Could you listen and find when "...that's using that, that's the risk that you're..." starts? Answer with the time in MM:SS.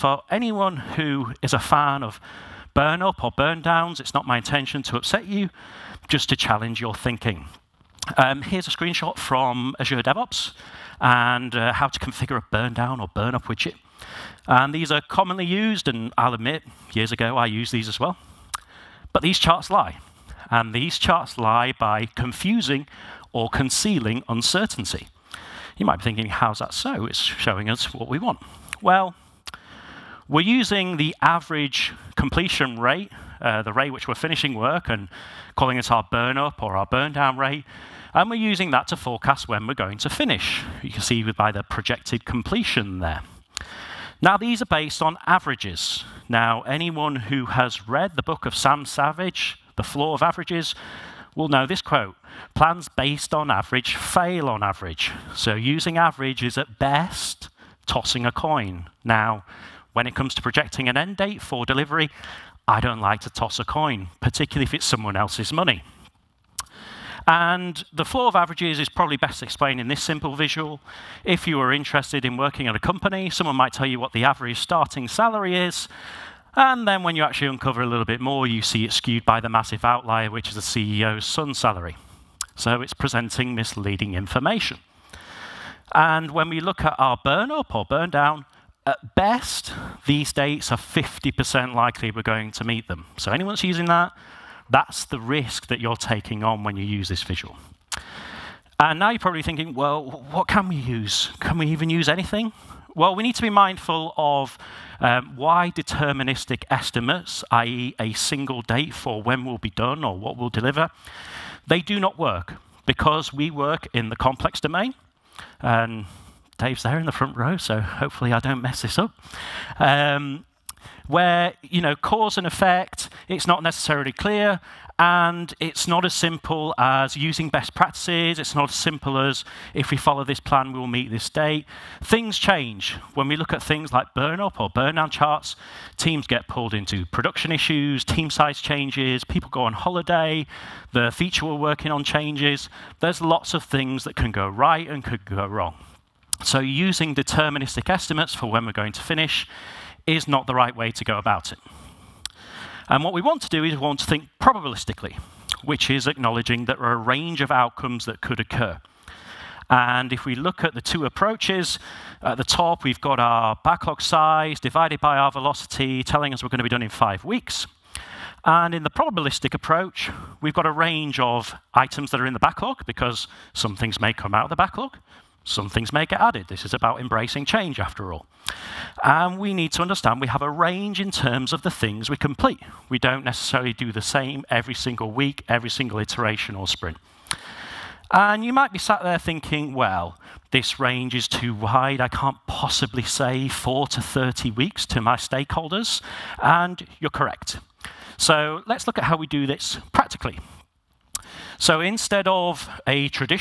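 01:33.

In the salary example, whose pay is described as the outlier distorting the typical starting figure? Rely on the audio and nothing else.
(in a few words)
The CEO's son.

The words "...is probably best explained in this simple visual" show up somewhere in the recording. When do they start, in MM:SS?
01:08.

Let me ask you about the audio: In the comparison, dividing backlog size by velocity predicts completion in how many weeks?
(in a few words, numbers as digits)
5 weeks.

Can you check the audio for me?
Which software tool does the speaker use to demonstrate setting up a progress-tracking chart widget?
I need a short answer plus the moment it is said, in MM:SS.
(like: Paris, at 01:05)
Azure DevOps, at 00:09.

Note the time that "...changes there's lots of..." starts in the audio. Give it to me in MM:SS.
02:22.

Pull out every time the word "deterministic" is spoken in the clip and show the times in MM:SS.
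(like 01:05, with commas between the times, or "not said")
01:45, 02:27.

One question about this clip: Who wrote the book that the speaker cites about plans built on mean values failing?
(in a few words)
Sam Savage.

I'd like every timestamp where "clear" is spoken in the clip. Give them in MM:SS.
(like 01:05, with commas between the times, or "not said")
02:04.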